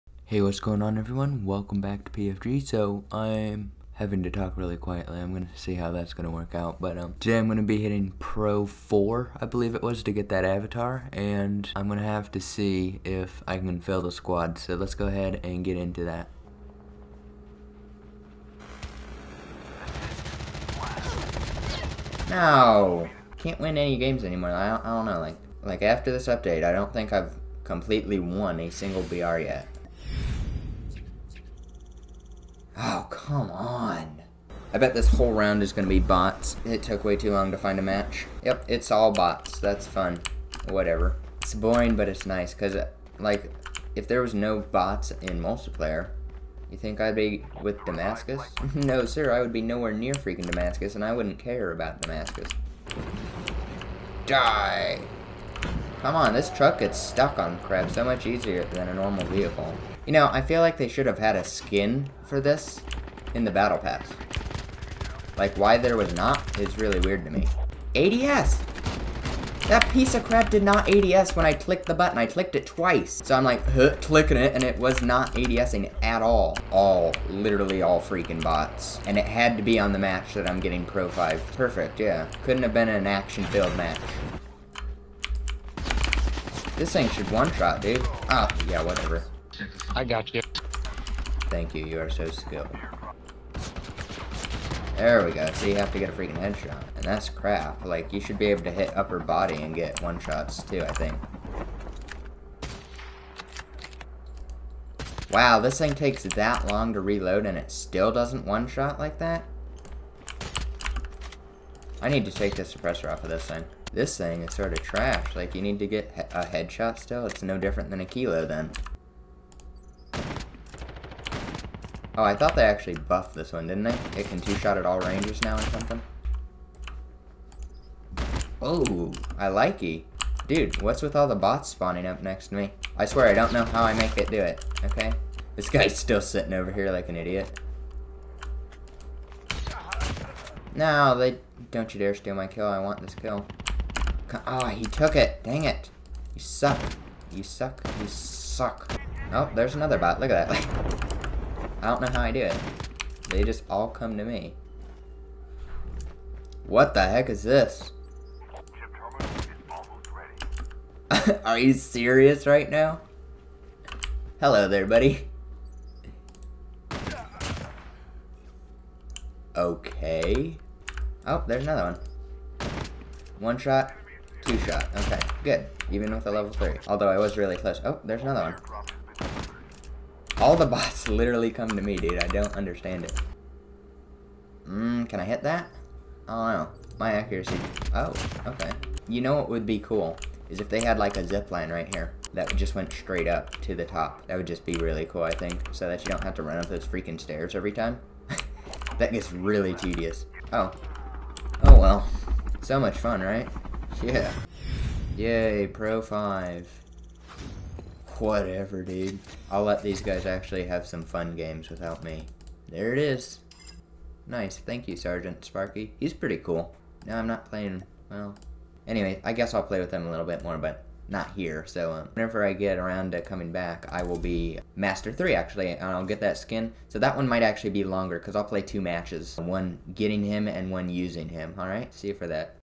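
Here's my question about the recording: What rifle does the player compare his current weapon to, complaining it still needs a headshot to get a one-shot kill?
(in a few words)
Kilo.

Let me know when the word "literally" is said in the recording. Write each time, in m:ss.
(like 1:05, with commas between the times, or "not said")
1:17, 3:01.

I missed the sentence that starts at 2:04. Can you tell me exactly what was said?
It can two-shot at all rangers now or something.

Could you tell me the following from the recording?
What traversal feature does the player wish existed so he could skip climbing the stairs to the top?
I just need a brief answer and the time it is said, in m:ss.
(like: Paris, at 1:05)
A zip line, at 3:11.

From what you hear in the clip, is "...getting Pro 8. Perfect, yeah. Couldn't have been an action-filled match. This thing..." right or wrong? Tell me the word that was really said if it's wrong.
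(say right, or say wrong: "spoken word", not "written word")
wrong: "5", not "8".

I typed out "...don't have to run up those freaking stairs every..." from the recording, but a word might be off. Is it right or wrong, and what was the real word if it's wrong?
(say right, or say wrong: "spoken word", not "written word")
right.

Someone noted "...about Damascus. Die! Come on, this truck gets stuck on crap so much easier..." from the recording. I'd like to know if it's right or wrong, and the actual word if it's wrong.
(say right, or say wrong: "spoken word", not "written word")
right.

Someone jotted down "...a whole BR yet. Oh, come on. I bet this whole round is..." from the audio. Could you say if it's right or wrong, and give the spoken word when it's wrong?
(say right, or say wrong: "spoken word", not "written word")
wrong: "single", not "whole".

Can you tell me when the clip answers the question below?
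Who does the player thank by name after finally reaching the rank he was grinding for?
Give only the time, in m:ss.
3:34.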